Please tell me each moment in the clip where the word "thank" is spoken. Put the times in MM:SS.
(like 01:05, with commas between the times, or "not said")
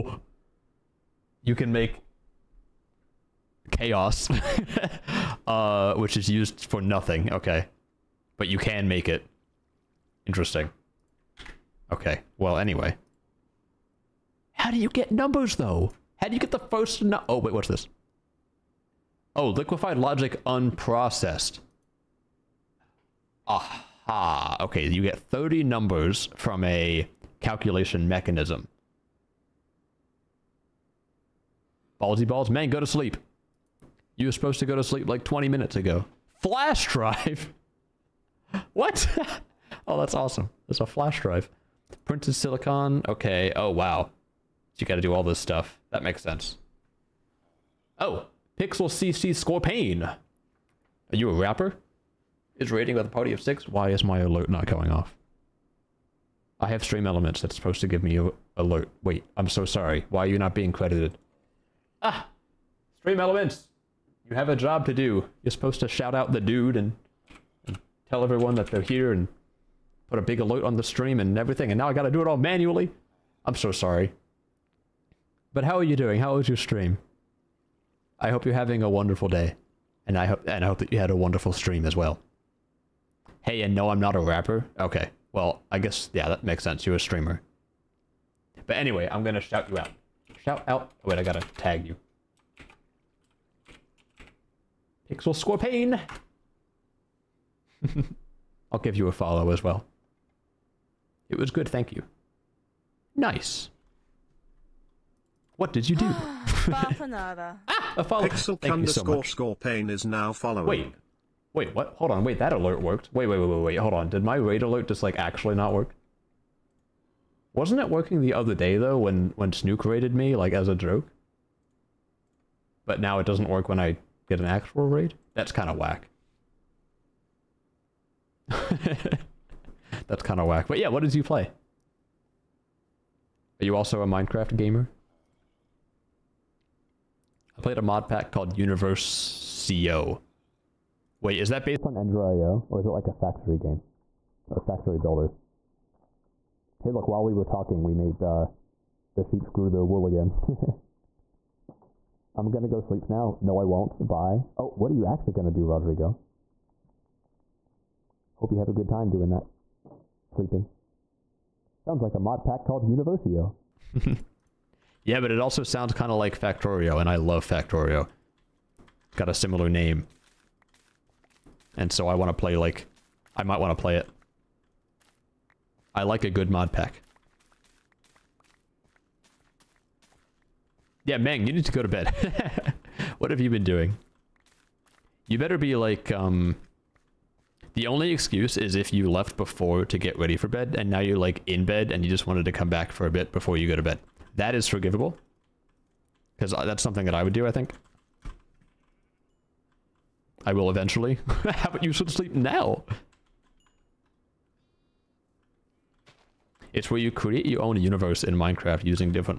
01:41, 01:48.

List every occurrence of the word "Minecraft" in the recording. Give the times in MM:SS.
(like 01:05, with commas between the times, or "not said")
02:14, 03:28.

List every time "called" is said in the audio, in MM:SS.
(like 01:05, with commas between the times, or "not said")
02:18, 02:42.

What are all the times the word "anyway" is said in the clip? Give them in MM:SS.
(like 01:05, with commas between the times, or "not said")
00:12, 01:28.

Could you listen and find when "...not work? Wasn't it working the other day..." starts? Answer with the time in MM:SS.
01:55.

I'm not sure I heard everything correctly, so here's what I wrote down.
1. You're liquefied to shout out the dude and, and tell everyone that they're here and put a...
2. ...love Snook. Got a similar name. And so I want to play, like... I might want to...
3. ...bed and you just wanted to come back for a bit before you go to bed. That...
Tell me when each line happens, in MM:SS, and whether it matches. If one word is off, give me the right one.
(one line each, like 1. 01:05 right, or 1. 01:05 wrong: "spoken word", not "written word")
1. 01:05 wrong: "supposed", not "liquefied"
2. 02:47 wrong: "Factorio", not "Snook"
3. 03:11 right.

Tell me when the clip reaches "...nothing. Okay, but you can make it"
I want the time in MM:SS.
00:06.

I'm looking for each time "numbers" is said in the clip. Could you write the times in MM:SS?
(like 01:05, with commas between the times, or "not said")
00:15, 00:25.